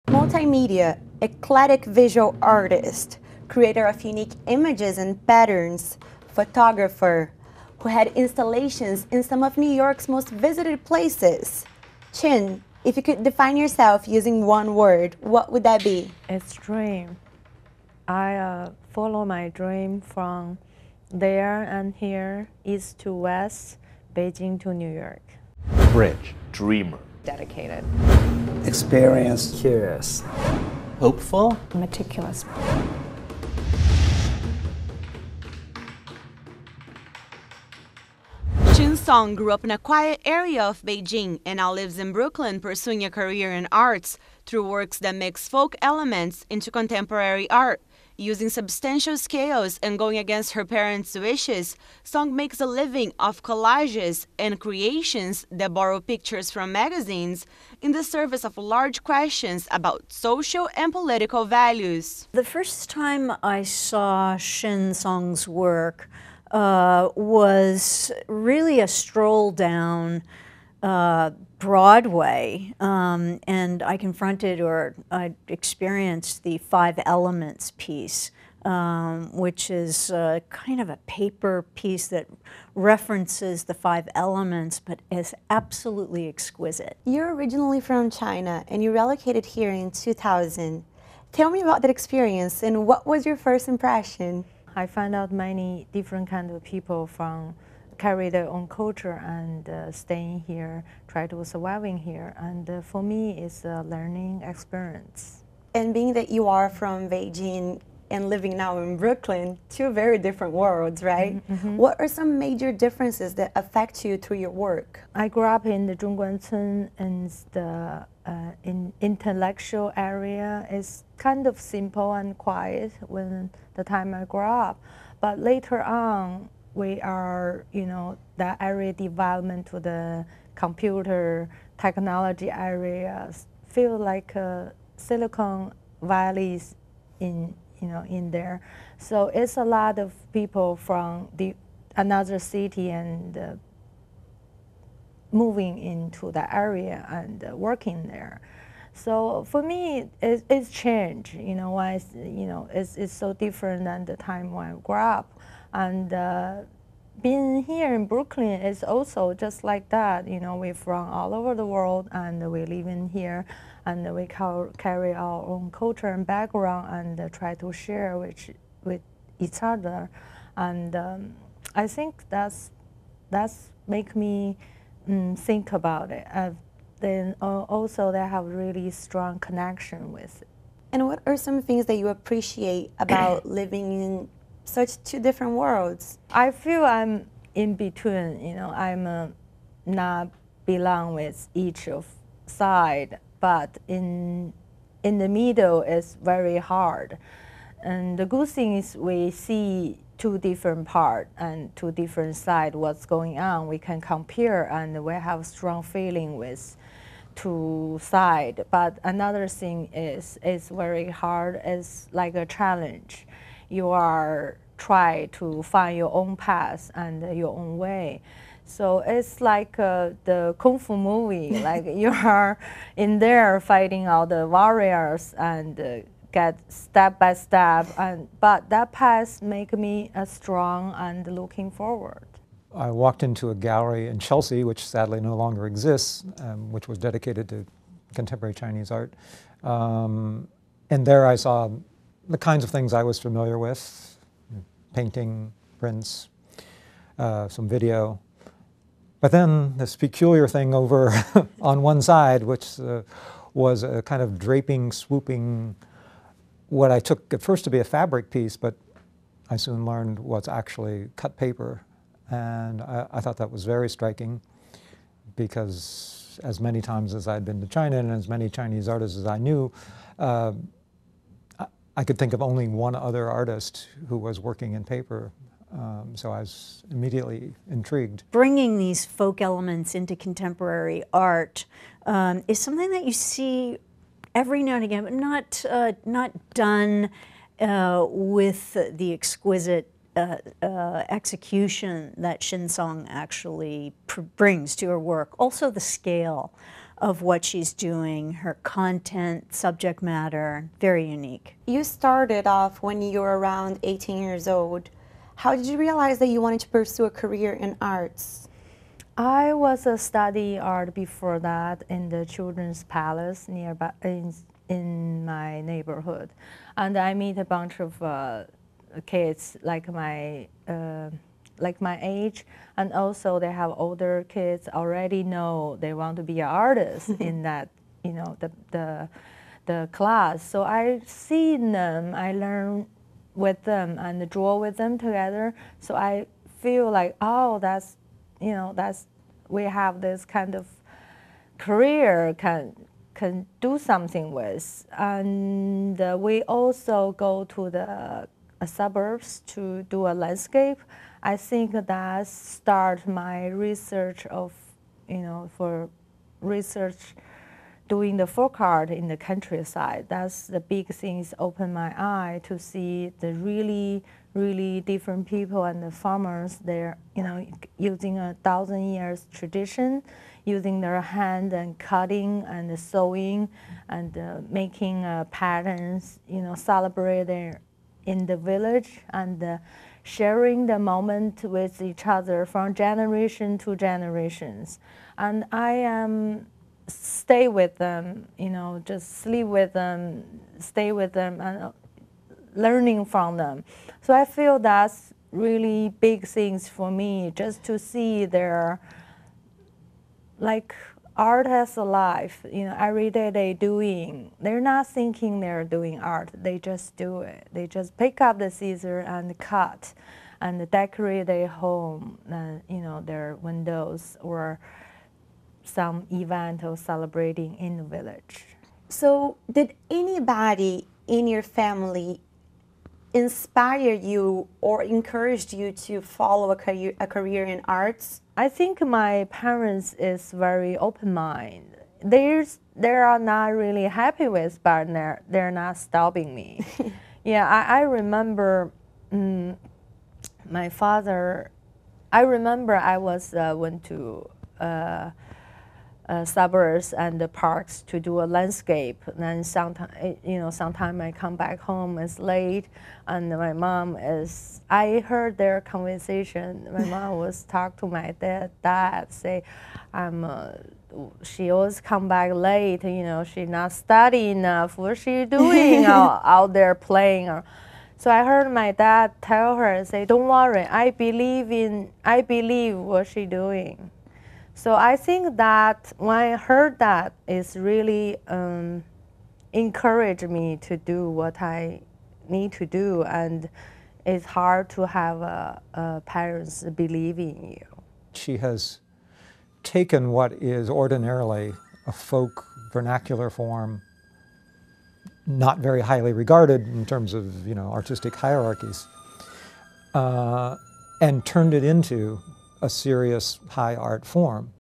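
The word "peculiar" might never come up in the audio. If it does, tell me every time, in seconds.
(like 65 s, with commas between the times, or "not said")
249 s.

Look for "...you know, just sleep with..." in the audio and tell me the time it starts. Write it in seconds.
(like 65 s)
388 s.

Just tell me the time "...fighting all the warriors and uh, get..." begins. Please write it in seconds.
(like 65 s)
223 s.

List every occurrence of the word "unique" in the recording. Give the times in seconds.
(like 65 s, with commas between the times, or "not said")
4 s, 301 s.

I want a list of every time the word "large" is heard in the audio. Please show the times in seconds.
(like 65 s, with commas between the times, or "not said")
58 s.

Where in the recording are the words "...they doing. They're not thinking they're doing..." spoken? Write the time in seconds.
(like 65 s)
403 s.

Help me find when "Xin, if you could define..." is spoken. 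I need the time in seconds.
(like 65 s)
12 s.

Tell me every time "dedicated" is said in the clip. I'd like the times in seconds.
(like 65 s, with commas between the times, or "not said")
27 s, 236 s.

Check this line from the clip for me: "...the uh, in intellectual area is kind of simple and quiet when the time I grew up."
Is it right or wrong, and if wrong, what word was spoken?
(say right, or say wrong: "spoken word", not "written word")
right.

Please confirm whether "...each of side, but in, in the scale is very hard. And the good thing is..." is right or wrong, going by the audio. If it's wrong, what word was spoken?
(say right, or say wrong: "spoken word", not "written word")
wrong: "middle", not "scale".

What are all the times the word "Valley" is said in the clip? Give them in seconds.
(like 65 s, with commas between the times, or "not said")
136 s.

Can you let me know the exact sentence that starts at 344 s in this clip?
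And uh, we also go to the suburbs to do a landscape.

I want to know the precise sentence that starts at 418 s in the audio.
So, did anybody in your family inspire you or encouraged you to follow a career, a career in arts?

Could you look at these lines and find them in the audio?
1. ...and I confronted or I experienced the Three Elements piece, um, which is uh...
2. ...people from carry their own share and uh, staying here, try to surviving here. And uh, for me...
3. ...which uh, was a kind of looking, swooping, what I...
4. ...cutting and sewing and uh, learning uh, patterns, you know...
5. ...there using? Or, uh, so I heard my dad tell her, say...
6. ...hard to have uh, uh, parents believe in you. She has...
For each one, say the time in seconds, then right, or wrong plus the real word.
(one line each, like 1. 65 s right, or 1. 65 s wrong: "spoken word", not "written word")
1. 73 s wrong: "Five", not "Three"
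2. 96 s wrong: "culture", not "share"
3. 252 s wrong: "draping", not "looking"
4. 371 s wrong: "making", not "learning"
5. 466 s wrong: "playing", not "using"
6. 484 s right.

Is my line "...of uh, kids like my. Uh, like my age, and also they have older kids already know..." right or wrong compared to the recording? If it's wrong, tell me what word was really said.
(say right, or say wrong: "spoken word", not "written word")
right.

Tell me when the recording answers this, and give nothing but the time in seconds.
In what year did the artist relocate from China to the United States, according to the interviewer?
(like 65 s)
89 s.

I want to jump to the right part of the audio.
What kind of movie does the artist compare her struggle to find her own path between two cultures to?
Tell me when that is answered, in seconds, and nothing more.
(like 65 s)
220 s.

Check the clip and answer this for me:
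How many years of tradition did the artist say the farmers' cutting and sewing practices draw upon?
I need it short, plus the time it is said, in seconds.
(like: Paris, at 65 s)
1000 years, at 368 s.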